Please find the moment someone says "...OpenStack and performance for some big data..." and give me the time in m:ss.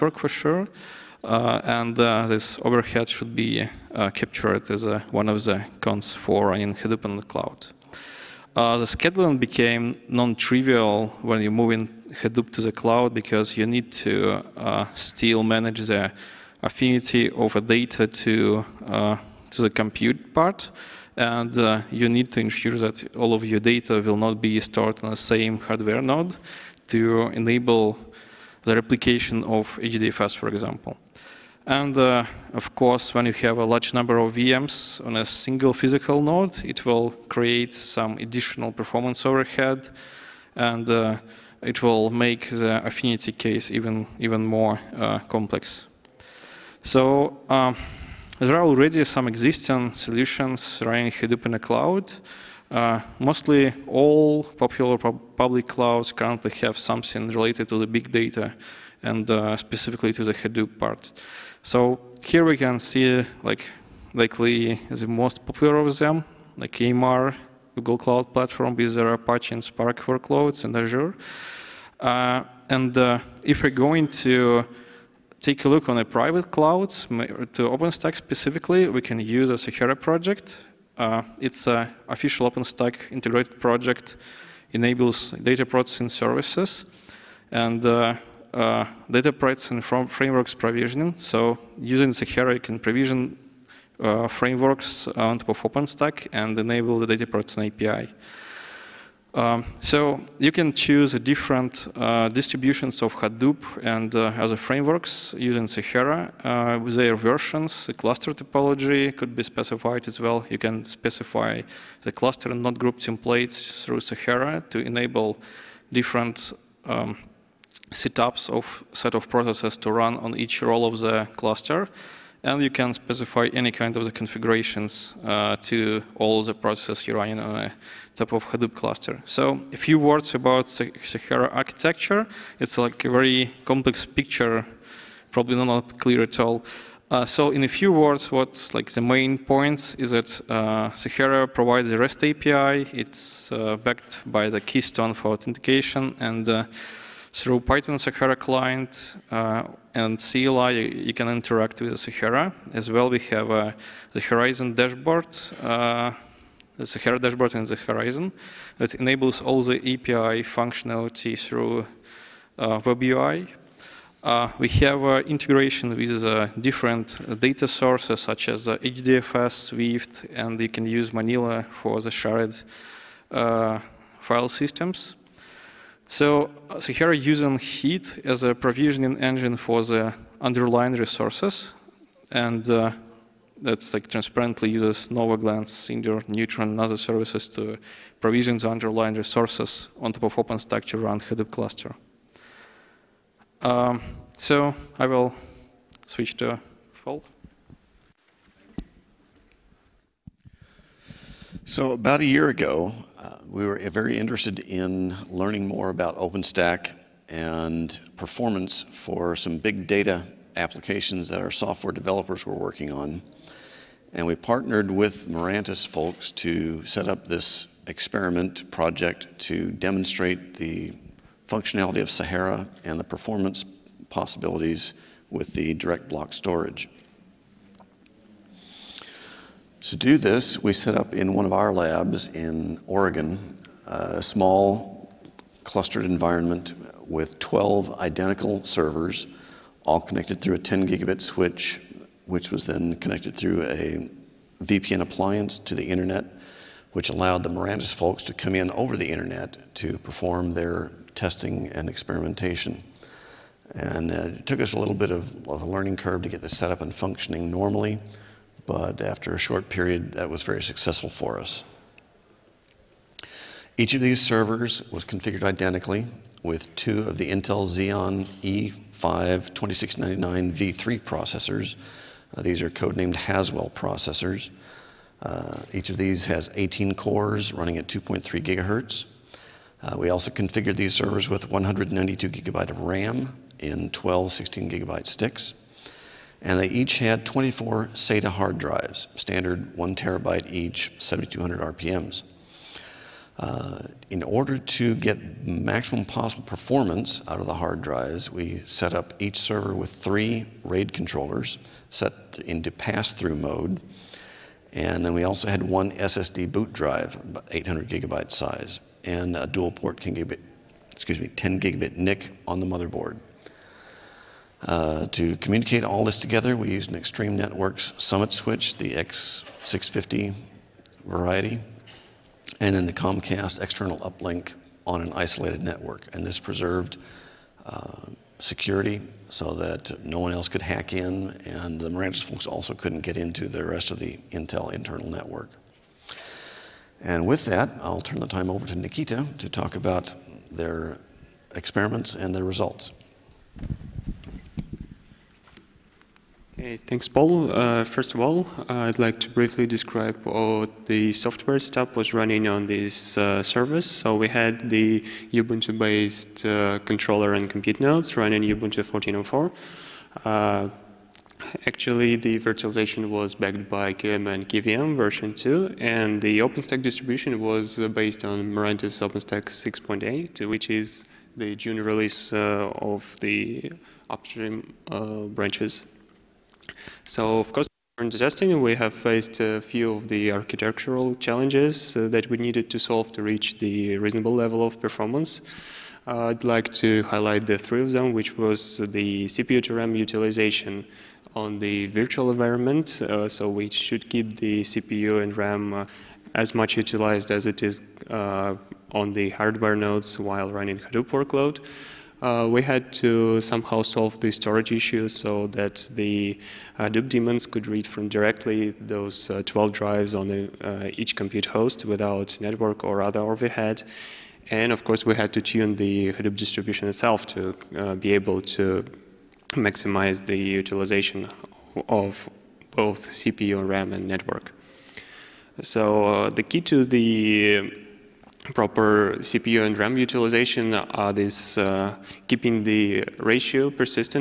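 3:26.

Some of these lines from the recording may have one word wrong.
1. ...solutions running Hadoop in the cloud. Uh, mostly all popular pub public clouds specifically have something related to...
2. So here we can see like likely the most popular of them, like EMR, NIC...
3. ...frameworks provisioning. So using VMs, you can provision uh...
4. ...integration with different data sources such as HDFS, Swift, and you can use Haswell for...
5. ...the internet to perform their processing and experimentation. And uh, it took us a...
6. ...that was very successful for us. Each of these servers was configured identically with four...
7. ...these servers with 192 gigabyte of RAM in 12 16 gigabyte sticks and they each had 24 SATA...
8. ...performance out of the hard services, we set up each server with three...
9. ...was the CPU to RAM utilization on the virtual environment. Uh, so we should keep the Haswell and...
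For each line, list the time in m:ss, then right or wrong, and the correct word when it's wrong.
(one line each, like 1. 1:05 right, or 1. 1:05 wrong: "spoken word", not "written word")
1. 0:49 wrong: "currently", not "specifically"
2. 1:01 wrong: "Google", not "NIC"
3. 1:30 wrong: "Sahara", not "VMs"
4. 2:45 wrong: "Manila", not "Haswell"
5. 4:08 wrong: "testing", not "processing"
6. 4:20 wrong: "two", not "four"
7. 4:40 right
8. 4:56 wrong: "drives", not "services"
9. 6:28 wrong: "CPU", not "Haswell".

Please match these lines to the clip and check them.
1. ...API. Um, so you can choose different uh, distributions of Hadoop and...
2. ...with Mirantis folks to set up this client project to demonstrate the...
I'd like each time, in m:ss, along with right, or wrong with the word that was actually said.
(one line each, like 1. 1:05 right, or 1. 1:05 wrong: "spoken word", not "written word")
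1. 1:37 right
2. 3:34 wrong: "experiment", not "client".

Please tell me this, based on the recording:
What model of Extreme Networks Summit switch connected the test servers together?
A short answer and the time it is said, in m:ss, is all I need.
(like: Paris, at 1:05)
X650, at 5:18.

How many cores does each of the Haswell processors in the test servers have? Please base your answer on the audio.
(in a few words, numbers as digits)
18.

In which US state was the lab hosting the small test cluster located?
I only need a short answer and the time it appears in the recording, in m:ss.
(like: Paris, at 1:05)
Oregon, at 3:52.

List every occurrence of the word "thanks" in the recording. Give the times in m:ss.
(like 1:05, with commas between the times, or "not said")
5:46.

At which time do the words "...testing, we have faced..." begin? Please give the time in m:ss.
6:18.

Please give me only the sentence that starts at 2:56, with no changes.
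So, uh, so here using heat as a provisioning engine for the underlying resources.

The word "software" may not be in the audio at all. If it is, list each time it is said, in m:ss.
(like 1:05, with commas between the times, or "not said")
3:31, 5:51.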